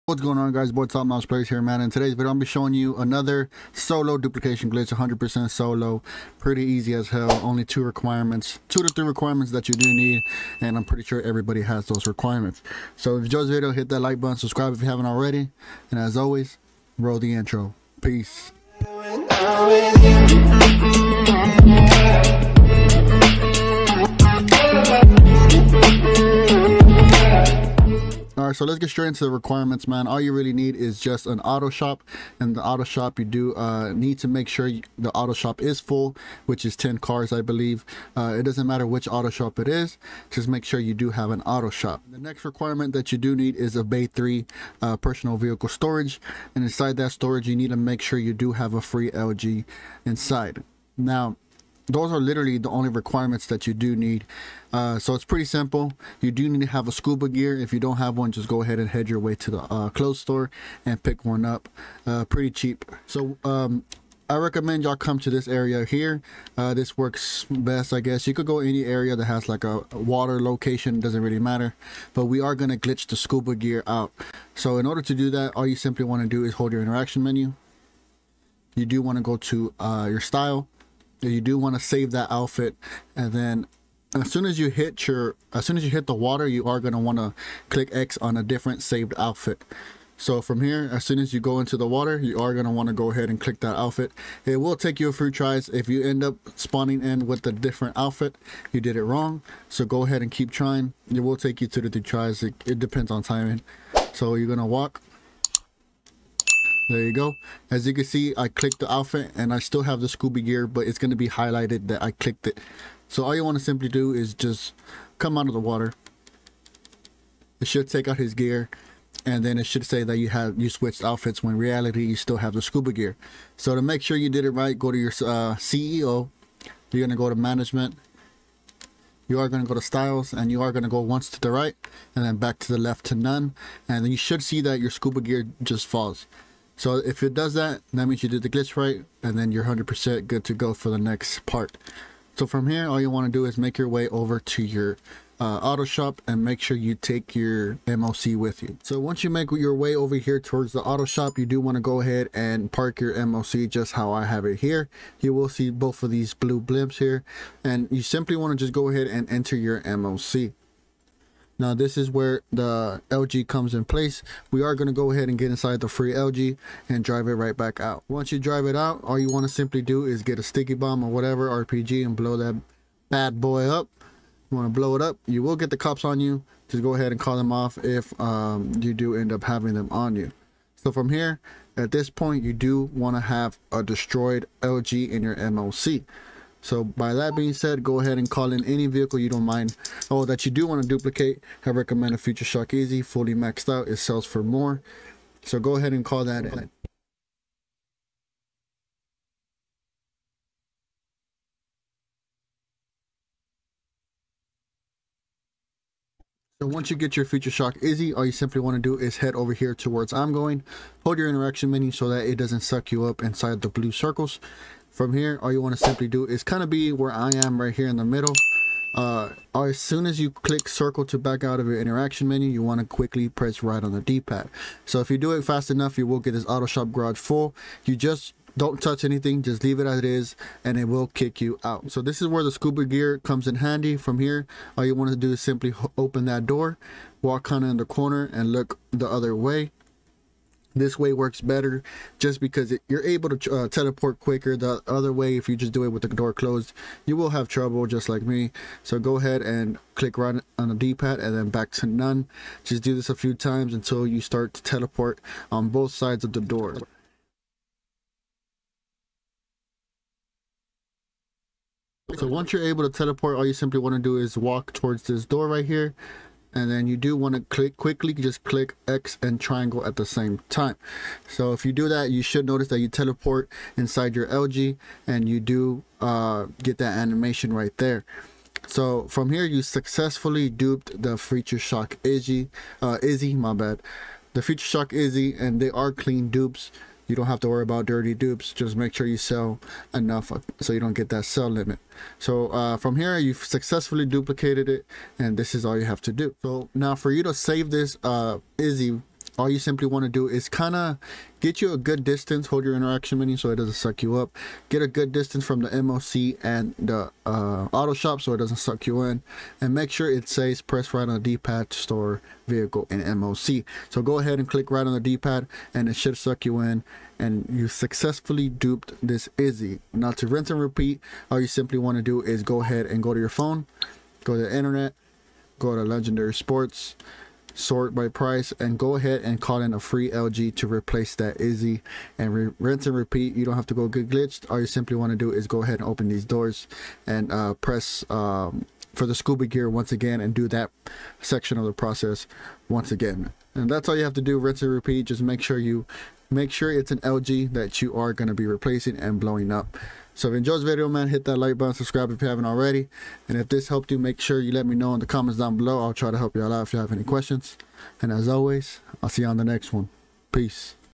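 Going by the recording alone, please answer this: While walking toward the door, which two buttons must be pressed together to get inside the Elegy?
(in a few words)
X and triangle.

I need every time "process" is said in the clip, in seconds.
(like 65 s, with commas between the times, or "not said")
341 s.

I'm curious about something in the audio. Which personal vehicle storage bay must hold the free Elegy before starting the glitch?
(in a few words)
Bay 3.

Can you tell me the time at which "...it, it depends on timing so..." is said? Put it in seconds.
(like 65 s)
102 s.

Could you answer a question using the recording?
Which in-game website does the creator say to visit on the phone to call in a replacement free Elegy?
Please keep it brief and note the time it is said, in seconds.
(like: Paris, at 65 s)
Legendary Sports, at 325 s.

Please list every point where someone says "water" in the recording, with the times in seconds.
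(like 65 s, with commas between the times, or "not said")
69 s, 86 s, 91 s, 115 s.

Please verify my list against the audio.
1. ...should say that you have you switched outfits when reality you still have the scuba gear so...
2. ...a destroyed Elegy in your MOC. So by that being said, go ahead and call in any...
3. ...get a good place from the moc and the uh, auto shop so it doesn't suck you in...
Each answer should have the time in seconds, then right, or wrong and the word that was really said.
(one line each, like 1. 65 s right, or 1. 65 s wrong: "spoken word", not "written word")
1. 119 s right
2. 183 s right
3. 304 s wrong: "distance", not "place".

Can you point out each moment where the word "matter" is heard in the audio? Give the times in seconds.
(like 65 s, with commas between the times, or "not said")
38 s, 71 s.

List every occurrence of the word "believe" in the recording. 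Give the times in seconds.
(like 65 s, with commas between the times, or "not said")
37 s.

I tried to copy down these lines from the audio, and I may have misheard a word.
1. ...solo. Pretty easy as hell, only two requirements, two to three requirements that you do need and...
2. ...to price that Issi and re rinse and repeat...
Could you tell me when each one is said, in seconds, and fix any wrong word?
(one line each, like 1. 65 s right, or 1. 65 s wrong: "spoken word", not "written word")
1. 5 s right
2. 330 s wrong: "replace", not "price".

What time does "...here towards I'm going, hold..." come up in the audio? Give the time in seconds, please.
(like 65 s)
209 s.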